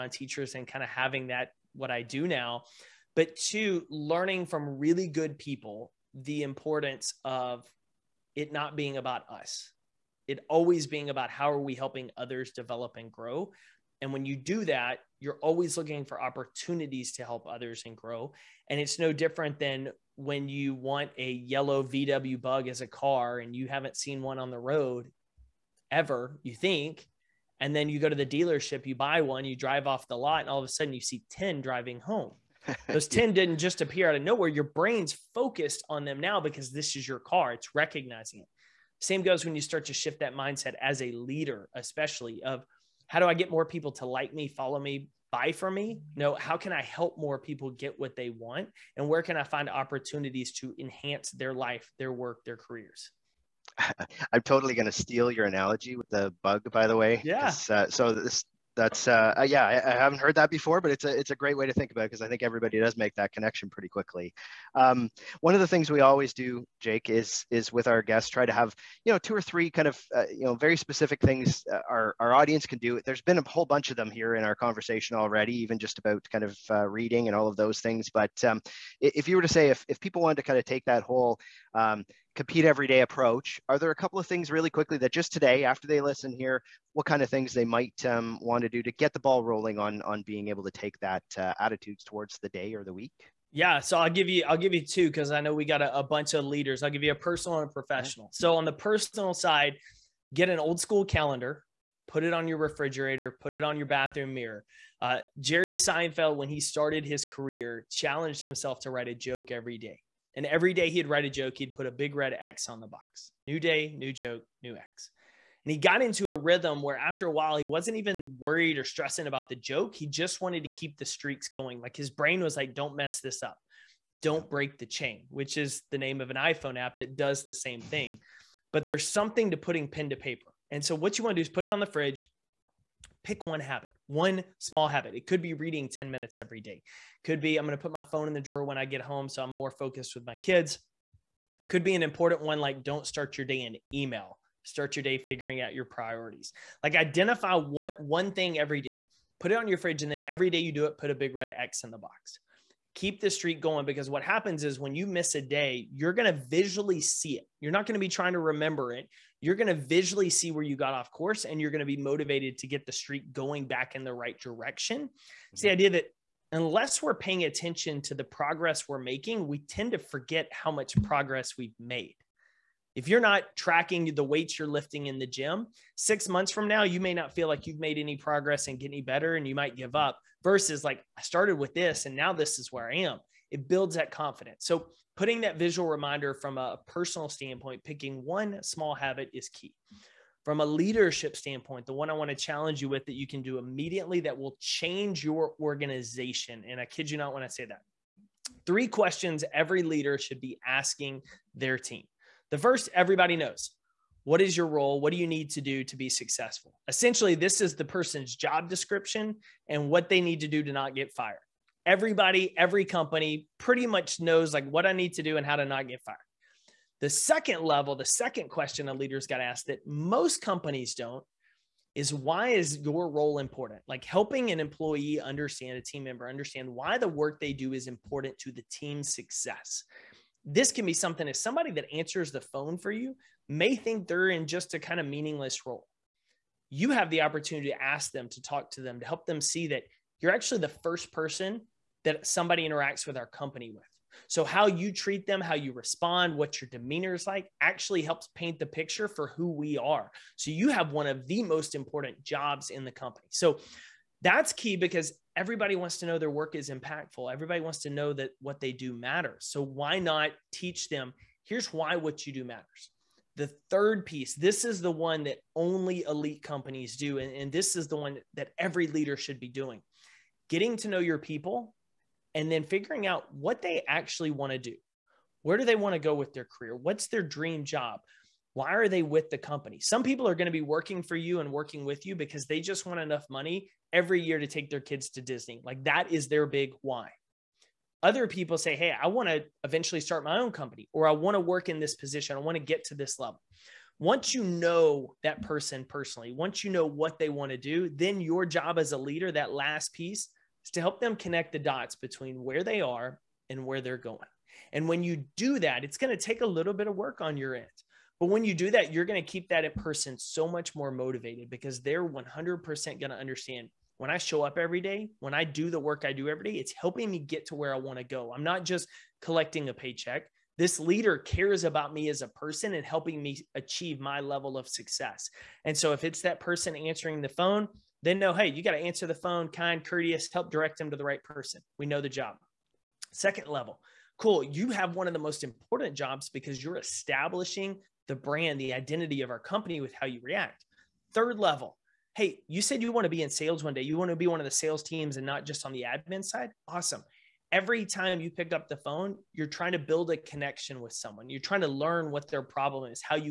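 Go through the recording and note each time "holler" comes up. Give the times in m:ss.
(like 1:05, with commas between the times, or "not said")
not said.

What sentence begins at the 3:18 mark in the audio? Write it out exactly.
Three questions every leader should be asking their team.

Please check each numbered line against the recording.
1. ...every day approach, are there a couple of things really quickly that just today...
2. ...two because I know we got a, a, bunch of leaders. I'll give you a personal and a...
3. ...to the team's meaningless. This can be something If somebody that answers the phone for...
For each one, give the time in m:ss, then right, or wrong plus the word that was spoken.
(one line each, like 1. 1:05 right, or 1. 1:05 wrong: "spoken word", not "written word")
1. 1:22 right
2. 1:34 right
3. 3:48 wrong: "success", not "meaningless".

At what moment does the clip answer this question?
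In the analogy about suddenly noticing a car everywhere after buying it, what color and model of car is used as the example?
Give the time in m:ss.
0:21.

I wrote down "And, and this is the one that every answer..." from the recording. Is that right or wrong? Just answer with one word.
wrong.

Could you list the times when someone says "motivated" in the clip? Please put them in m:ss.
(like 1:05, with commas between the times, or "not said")
2:41, 5:10.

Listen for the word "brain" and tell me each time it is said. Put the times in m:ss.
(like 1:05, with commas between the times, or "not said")
0:34, 2:02.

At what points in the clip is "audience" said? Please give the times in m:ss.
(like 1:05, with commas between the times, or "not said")
1:12.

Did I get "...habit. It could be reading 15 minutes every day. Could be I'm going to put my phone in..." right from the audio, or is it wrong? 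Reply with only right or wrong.
wrong.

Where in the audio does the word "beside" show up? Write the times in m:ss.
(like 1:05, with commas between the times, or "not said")
not said.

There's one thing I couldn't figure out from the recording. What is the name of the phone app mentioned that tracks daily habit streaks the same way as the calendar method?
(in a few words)
Don't Break the Chain.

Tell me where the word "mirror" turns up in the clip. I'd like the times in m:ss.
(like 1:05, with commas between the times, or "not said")
1:44.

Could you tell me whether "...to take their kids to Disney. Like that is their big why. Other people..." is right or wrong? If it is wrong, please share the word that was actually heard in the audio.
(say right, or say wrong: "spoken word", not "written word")
right.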